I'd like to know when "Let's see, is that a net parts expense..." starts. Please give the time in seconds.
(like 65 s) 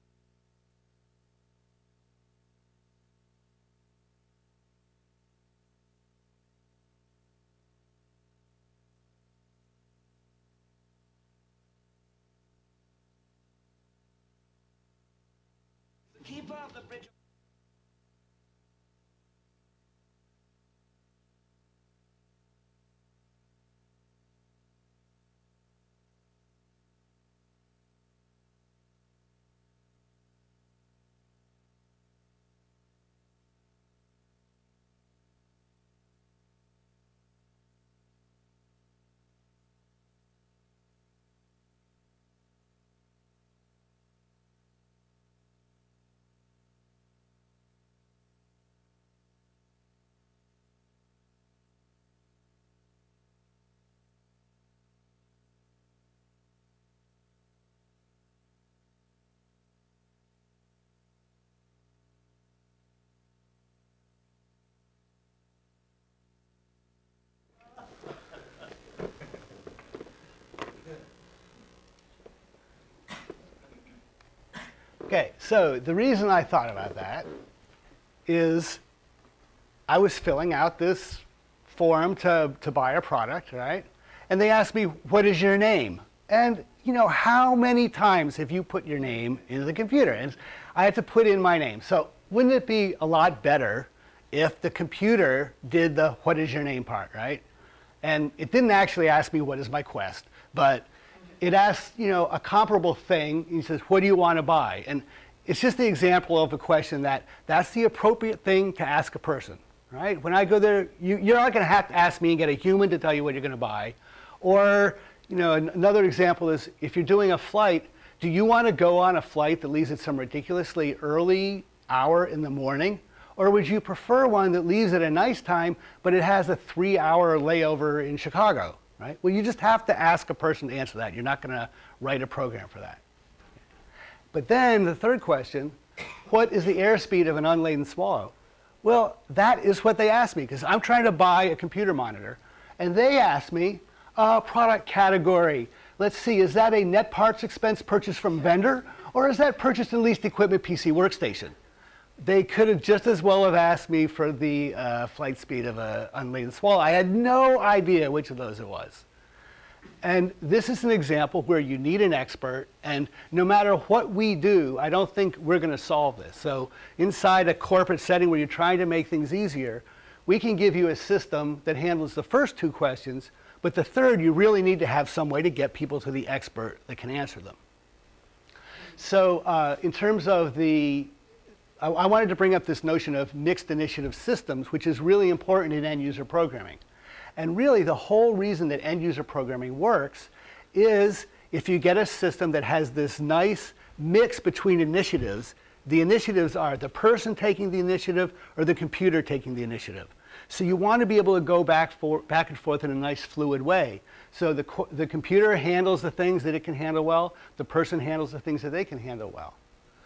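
145 s.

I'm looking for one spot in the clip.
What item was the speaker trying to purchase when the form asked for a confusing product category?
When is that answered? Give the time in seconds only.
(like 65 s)
141 s.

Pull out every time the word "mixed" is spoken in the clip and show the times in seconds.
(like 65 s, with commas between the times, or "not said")
183 s.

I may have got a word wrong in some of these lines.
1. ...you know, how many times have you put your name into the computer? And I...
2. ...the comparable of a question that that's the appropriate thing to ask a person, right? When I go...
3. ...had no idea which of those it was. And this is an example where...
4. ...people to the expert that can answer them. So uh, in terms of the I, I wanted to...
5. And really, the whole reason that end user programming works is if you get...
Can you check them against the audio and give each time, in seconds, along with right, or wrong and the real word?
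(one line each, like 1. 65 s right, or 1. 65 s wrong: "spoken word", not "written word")
1. 86 s right
2. 105 s wrong: "example", not "comparable"
3. 156 s right
4. 175 s right
5. 187 s right.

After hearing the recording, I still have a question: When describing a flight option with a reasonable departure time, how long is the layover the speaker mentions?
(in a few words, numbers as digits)
3 hours.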